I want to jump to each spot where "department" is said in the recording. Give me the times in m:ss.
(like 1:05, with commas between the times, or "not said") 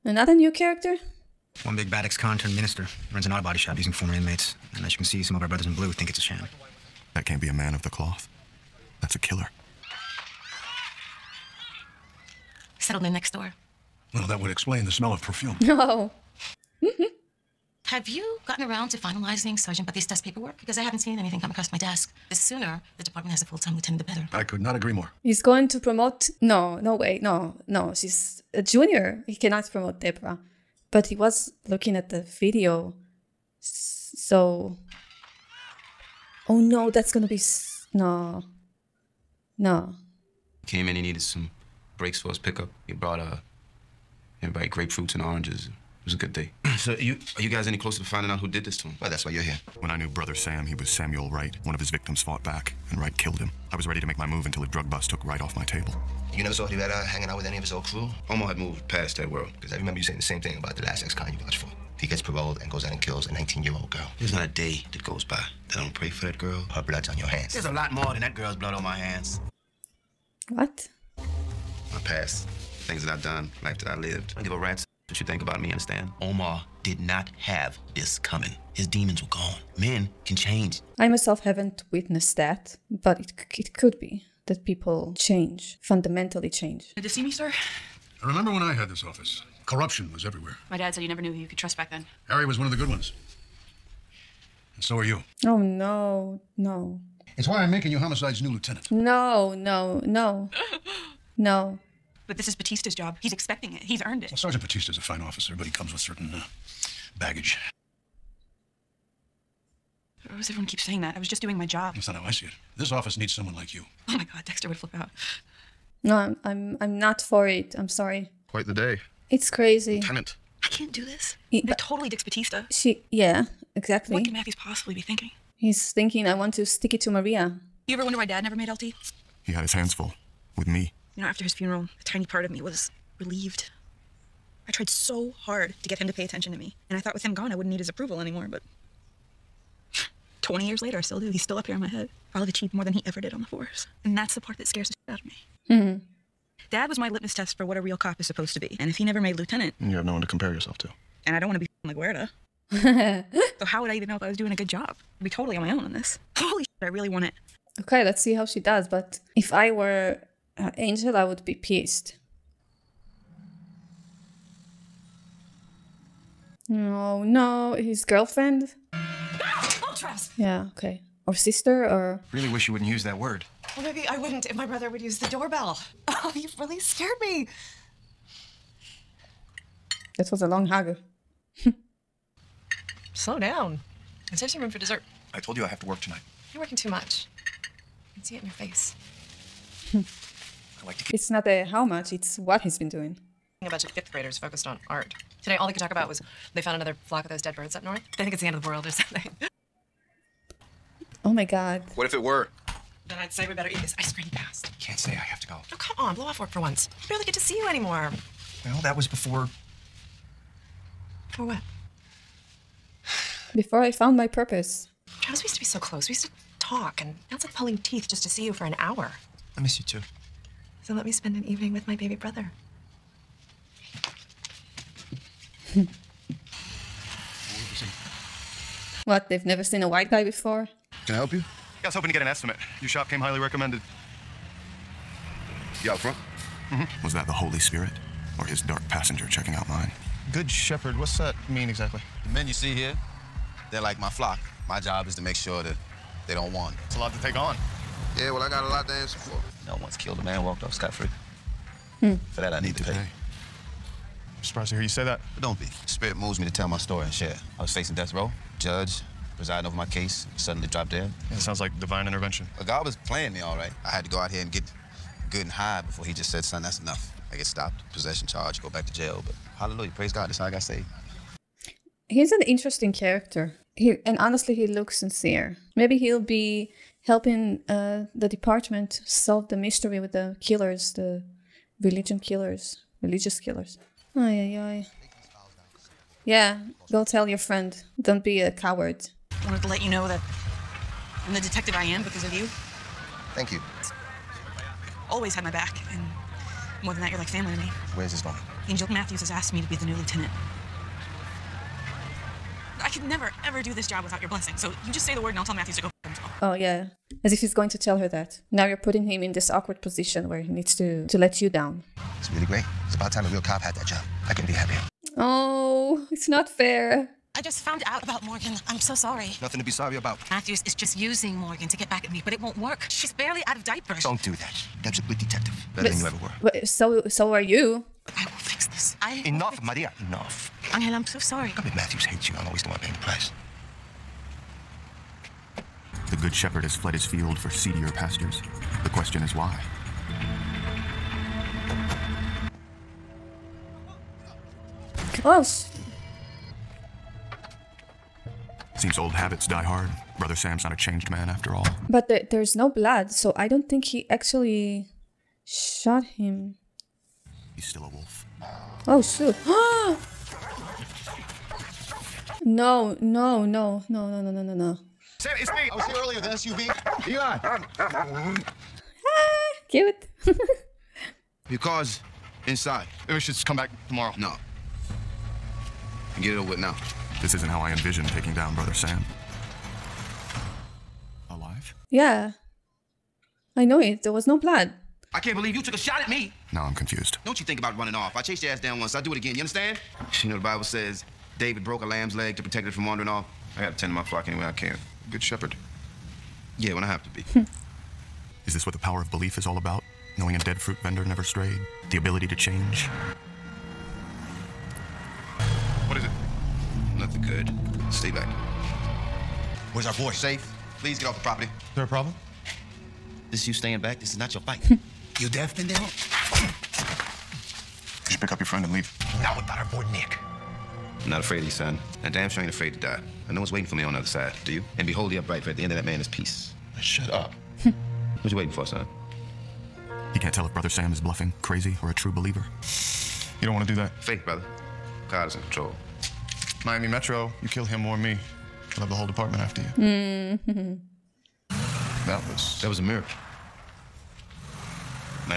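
0:23, 4:38, 7:19.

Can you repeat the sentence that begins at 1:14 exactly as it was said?
I give a rat's what you think about me, understand?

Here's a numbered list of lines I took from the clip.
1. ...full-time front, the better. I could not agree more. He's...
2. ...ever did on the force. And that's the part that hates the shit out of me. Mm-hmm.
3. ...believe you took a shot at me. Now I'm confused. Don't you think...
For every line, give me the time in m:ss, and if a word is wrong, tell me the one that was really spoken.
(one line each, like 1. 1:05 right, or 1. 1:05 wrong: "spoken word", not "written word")
1. 0:23 wrong: "lieutenant", not "front"
2. 2:23 wrong: "scares", not "hates"
3. 6:25 right.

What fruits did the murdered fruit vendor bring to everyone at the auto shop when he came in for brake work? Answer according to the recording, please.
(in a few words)
grapefruits and oranges.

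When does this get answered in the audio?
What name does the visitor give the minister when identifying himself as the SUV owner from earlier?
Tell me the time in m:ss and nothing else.
6:07.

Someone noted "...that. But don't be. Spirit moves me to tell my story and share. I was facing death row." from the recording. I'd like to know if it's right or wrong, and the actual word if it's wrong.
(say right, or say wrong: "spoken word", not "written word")
right.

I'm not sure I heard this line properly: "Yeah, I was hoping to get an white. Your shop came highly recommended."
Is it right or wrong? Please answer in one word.
wrong.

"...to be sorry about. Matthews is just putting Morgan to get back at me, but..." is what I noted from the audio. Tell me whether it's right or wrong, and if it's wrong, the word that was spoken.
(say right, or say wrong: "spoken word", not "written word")
wrong: "using", not "putting".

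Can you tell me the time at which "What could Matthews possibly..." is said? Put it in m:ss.
2:04.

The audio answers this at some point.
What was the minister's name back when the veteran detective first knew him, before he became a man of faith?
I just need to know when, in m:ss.
0:50.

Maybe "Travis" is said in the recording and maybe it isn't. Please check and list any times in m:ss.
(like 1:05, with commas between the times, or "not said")
2:49, 3:35.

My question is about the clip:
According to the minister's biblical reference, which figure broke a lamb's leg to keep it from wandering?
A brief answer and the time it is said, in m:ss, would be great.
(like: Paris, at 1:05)
David, at 6:31.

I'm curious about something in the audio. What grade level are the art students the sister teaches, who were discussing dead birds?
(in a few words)
fifth graders.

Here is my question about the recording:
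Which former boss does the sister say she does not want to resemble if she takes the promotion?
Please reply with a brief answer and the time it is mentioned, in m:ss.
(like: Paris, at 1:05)
LaGuerta, at 2:31.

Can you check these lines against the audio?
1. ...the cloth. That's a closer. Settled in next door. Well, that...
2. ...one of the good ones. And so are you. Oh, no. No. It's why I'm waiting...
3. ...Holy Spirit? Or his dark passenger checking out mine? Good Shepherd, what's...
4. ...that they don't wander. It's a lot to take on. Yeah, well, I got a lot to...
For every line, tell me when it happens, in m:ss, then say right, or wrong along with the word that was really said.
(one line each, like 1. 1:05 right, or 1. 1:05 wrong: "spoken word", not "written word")
1. 0:07 wrong: "killer", not "closer"
2. 1:32 wrong: "making", not "waiting"
3. 3:57 right
4. 4:05 right.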